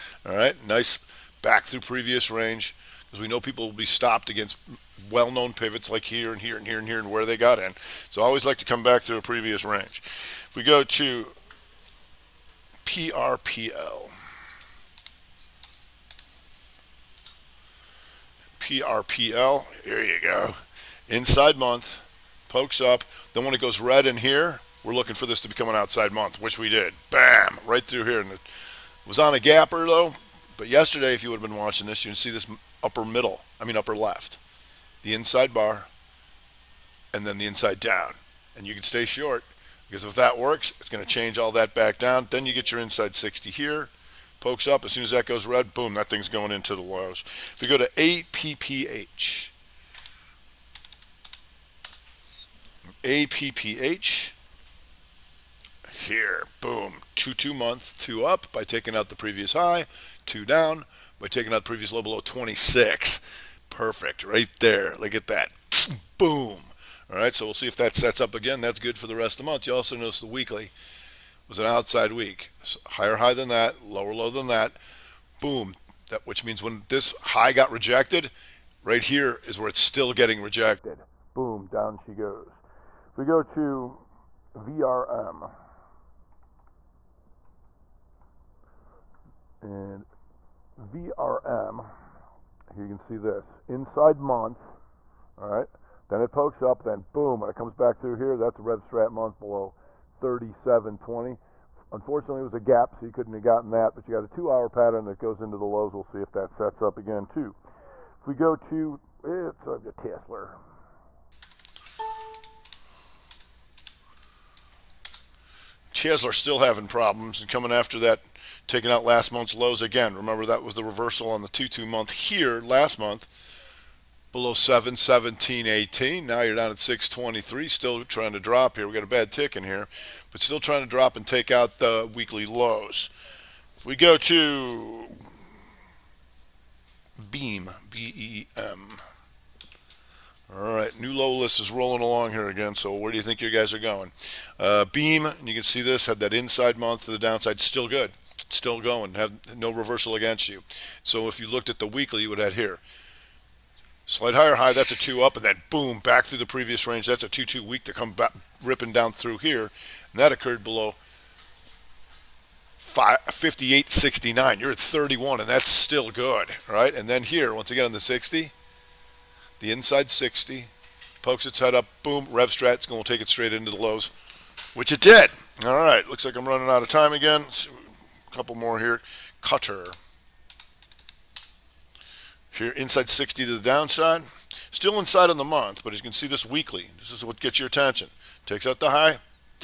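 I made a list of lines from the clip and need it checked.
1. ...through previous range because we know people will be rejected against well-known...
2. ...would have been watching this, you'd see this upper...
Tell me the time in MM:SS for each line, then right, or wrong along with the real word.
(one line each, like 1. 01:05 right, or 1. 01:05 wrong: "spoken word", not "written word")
1. 00:01 wrong: "stopped", not "rejected"
2. 00:31 right.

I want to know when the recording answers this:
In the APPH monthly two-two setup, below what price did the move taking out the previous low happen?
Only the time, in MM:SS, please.
01:02.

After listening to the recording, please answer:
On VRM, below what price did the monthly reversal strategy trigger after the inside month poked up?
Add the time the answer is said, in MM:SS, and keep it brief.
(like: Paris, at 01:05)
37.20, at 01:40.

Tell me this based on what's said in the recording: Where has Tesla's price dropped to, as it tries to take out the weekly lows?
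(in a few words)
623.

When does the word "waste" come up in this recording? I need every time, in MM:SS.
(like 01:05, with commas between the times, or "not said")
not said.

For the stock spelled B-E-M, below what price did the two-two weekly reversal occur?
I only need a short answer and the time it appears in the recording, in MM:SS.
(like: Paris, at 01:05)
58.69, at 02:42.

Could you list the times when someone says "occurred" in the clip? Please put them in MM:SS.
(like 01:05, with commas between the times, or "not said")
02:40.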